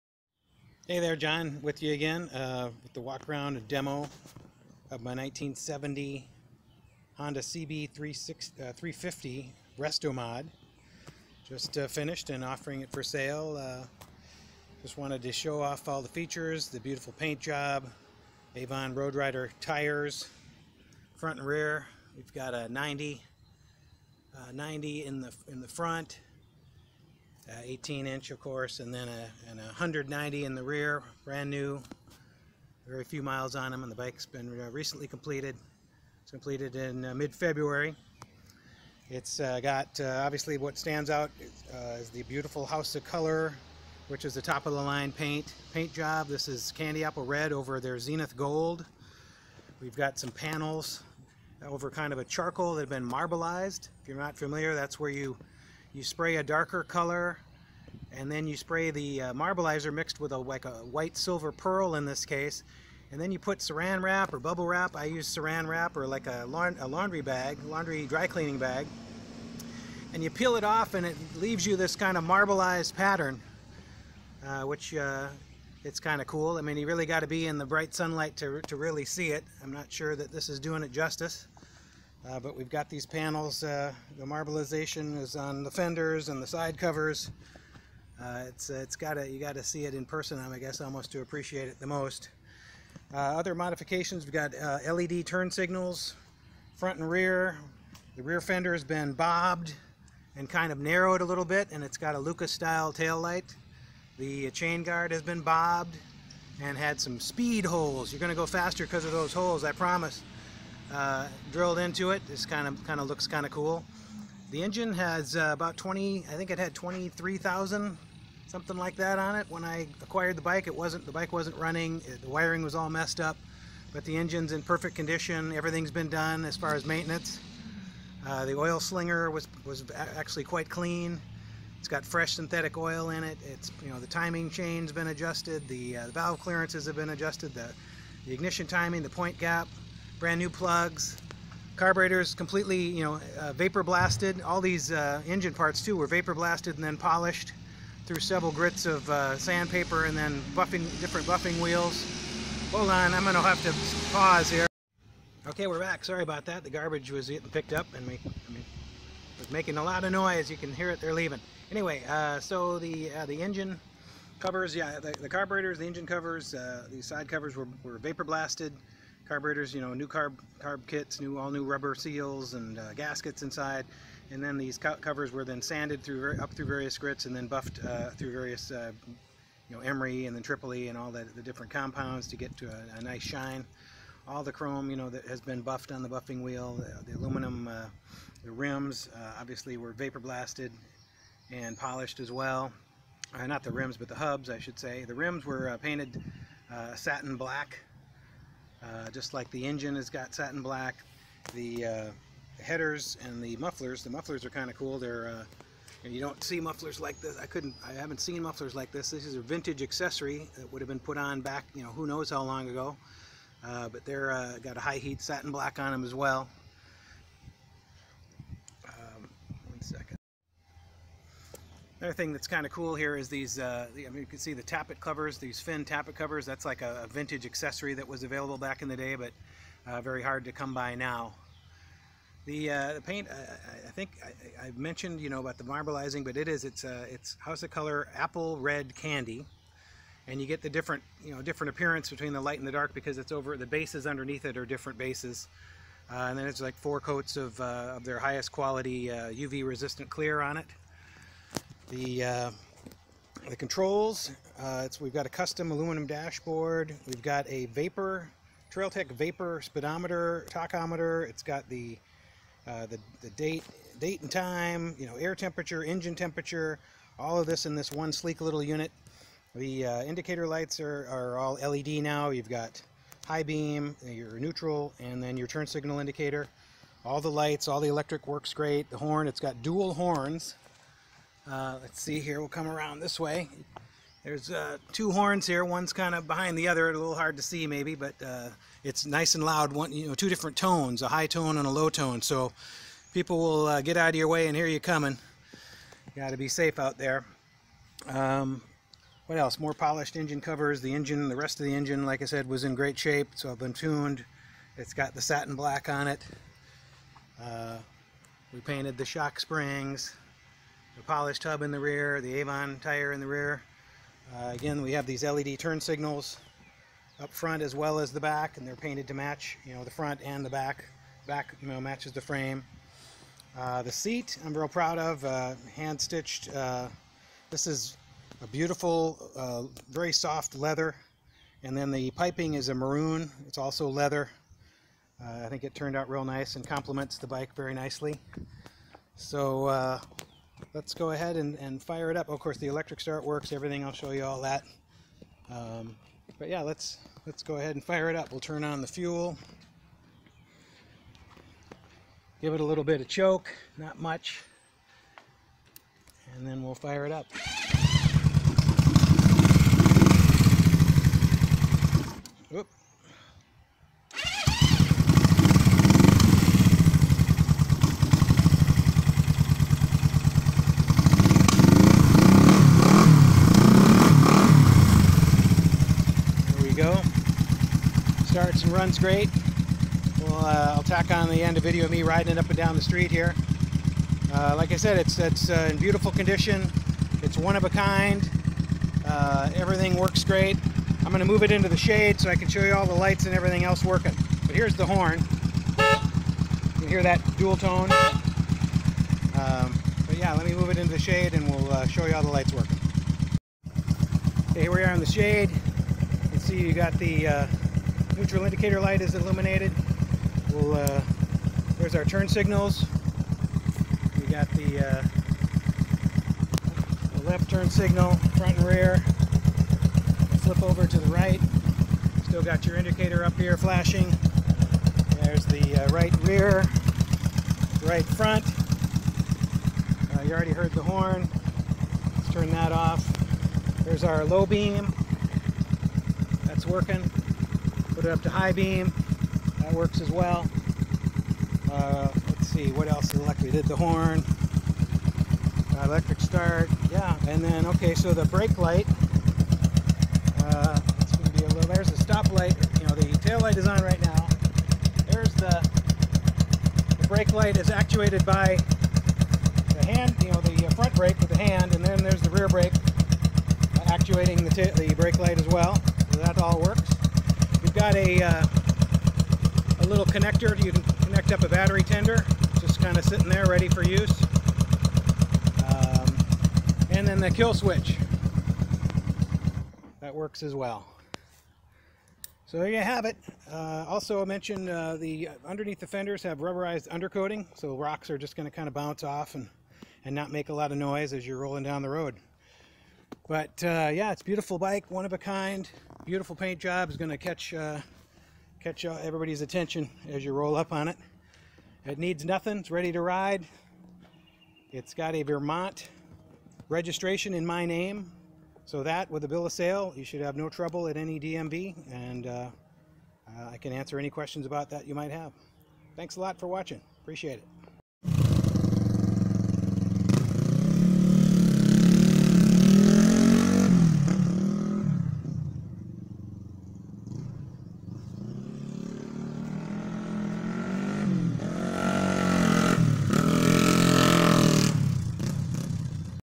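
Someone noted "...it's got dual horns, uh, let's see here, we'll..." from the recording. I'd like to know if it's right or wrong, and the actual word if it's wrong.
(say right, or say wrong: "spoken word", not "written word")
right.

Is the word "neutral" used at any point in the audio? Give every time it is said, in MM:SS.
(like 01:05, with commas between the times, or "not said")
04:34, 06:48.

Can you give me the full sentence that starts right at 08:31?
And uh, uh, I can answer any questions about that you might have.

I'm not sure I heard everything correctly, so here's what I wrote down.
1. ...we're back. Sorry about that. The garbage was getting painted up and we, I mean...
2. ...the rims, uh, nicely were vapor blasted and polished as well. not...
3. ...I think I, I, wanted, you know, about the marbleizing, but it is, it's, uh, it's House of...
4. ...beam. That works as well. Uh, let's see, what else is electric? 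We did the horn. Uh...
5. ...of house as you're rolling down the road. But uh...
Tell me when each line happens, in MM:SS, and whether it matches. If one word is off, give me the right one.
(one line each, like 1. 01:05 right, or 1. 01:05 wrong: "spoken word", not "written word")
1. 02:35 wrong: "picked", not "painted"
2. 03:08 wrong: "obviously", not "nicely"
3. 03:53 wrong: "mentioned", not "wanted"
4. 07:18 right
5. 08:10 wrong: "noise", not "house".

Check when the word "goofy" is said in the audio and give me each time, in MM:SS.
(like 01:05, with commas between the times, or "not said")
not said.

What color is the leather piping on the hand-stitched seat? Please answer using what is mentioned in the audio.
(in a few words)
Maroon.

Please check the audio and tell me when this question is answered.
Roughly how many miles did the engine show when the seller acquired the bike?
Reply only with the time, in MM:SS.
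01:56.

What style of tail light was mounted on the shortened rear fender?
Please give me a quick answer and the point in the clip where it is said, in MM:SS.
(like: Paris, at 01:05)
Lucas-style, at 01:42.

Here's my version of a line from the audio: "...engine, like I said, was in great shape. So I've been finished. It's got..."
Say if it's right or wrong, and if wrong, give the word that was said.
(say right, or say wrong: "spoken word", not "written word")
wrong: "tuned", not "finished".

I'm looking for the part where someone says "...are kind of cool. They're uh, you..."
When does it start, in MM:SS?
03:24.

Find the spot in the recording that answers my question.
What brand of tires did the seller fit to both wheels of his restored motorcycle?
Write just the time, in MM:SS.
00:18.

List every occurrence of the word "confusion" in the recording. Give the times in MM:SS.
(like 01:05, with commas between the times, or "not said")
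not said.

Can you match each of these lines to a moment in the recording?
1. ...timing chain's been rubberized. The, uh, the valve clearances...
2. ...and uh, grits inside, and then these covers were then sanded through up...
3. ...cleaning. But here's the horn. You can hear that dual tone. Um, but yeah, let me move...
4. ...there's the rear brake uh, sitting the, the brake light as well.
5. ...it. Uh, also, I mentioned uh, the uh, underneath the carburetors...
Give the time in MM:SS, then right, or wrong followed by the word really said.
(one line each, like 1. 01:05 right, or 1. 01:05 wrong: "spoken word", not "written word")
1. 02:14 wrong: "adjusted", not "rubberized"
2. 02:52 wrong: "gaskets", not "grits"
3. 06:33 wrong: "working", not "cleaning"
4. 07:41 wrong: "actuating", not "sitting"
5. 08:03 wrong: "fenders", not "carburetors".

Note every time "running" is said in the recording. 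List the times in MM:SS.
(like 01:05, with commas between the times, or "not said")
02:01.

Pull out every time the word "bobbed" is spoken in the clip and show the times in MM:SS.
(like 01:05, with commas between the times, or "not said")
01:39, 01:45.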